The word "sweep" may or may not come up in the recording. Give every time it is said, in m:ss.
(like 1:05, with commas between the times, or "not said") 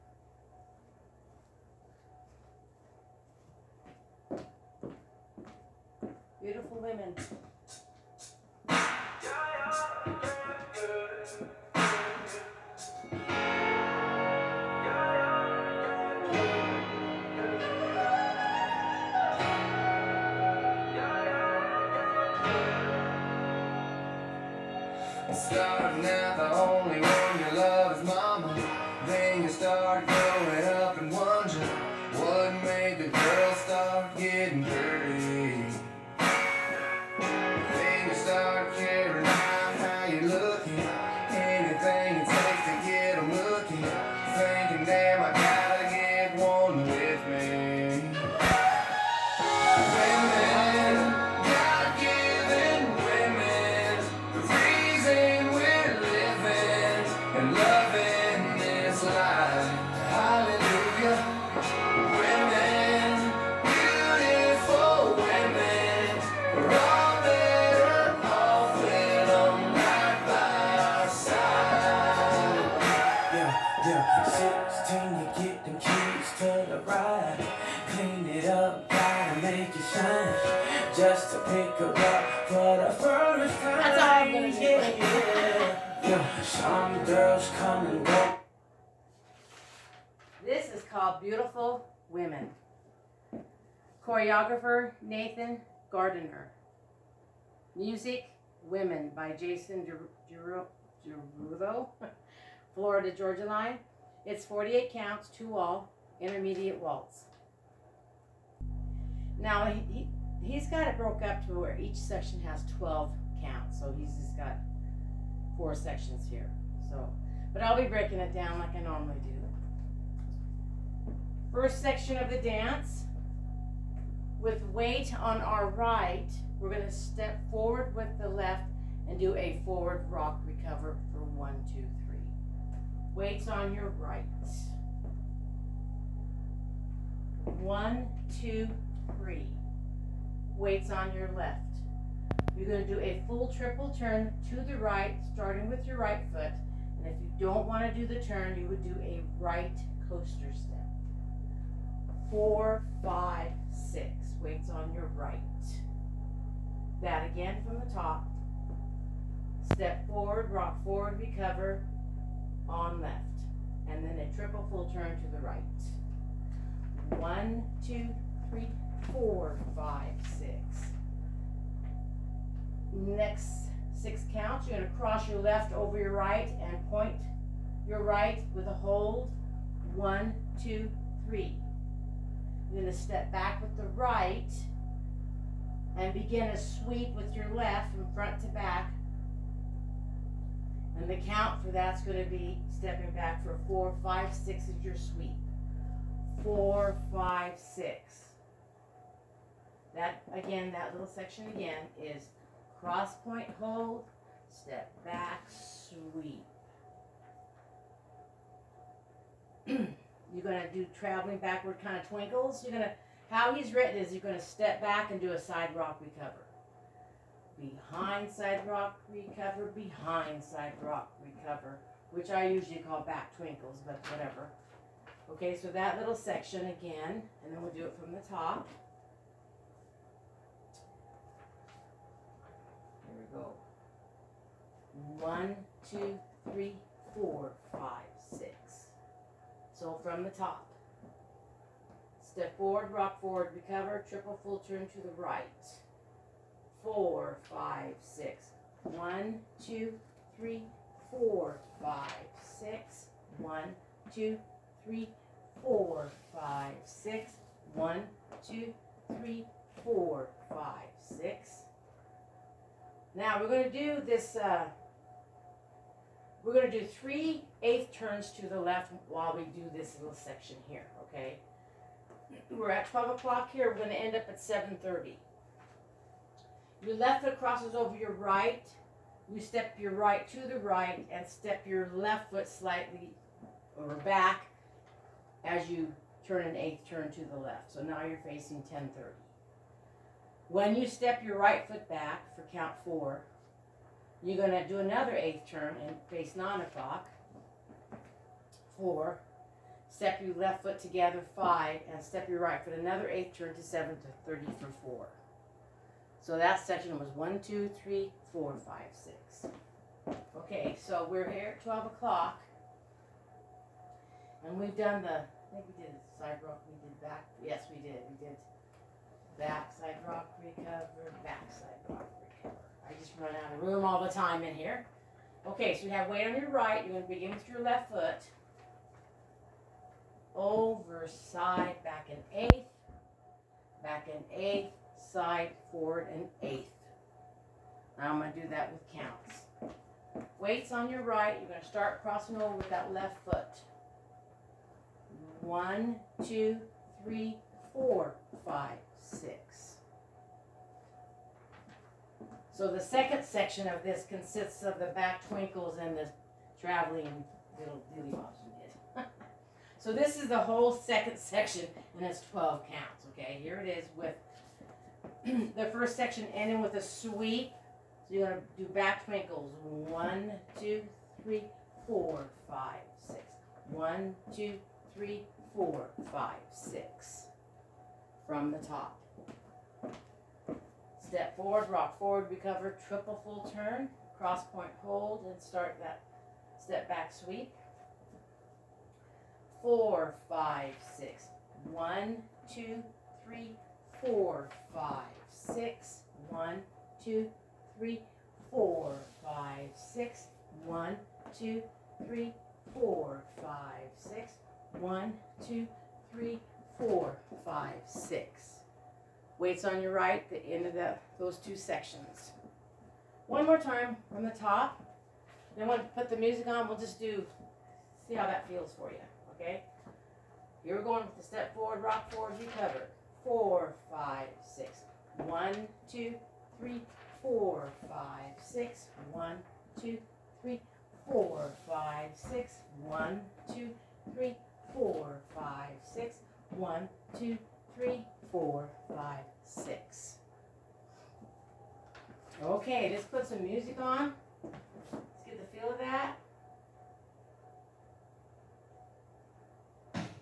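3:06, 3:14, 3:25, 6:06, 6:27.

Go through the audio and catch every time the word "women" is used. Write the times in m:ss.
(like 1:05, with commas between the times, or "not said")
0:06, 1:32, 1:38.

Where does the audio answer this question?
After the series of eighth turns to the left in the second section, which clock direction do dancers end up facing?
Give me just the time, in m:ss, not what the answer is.
4:34.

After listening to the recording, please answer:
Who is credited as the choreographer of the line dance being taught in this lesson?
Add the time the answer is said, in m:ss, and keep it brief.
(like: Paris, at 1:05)
Nathan Gardiner, at 1:35.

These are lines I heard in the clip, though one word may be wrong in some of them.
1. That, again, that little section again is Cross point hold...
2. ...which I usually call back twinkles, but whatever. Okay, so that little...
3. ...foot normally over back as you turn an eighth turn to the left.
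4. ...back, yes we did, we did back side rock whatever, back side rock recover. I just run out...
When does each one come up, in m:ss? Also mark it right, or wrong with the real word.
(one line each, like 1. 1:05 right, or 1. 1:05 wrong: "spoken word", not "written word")
1. 3:19 right
2. 3:42 right
3. 4:42 wrong: "slightly", not "normally"
4. 5:17 wrong: "recover", not "whatever".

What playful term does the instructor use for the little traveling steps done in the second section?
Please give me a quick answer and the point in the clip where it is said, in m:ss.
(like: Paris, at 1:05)
dilly bobs, at 5:57.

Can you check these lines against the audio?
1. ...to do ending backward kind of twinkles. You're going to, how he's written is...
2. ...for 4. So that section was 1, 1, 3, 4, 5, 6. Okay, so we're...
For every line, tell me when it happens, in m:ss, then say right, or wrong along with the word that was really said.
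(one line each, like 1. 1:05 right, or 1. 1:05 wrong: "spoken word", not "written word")
1. 3:30 wrong: "traveling", not "ending"
2. 5:04 wrong: "2", not "1".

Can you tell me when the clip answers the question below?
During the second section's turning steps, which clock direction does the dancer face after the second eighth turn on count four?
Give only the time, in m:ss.
4:56.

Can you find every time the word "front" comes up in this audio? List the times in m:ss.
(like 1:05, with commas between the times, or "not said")
3:08.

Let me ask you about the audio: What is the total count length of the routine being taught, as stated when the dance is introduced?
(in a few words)
48.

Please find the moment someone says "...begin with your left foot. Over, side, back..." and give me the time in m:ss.
5:27.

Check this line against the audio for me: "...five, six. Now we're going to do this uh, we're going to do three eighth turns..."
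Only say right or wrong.
right.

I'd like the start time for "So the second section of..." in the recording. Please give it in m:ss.
5:52.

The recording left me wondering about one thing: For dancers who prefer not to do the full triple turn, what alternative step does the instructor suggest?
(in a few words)
right coaster step.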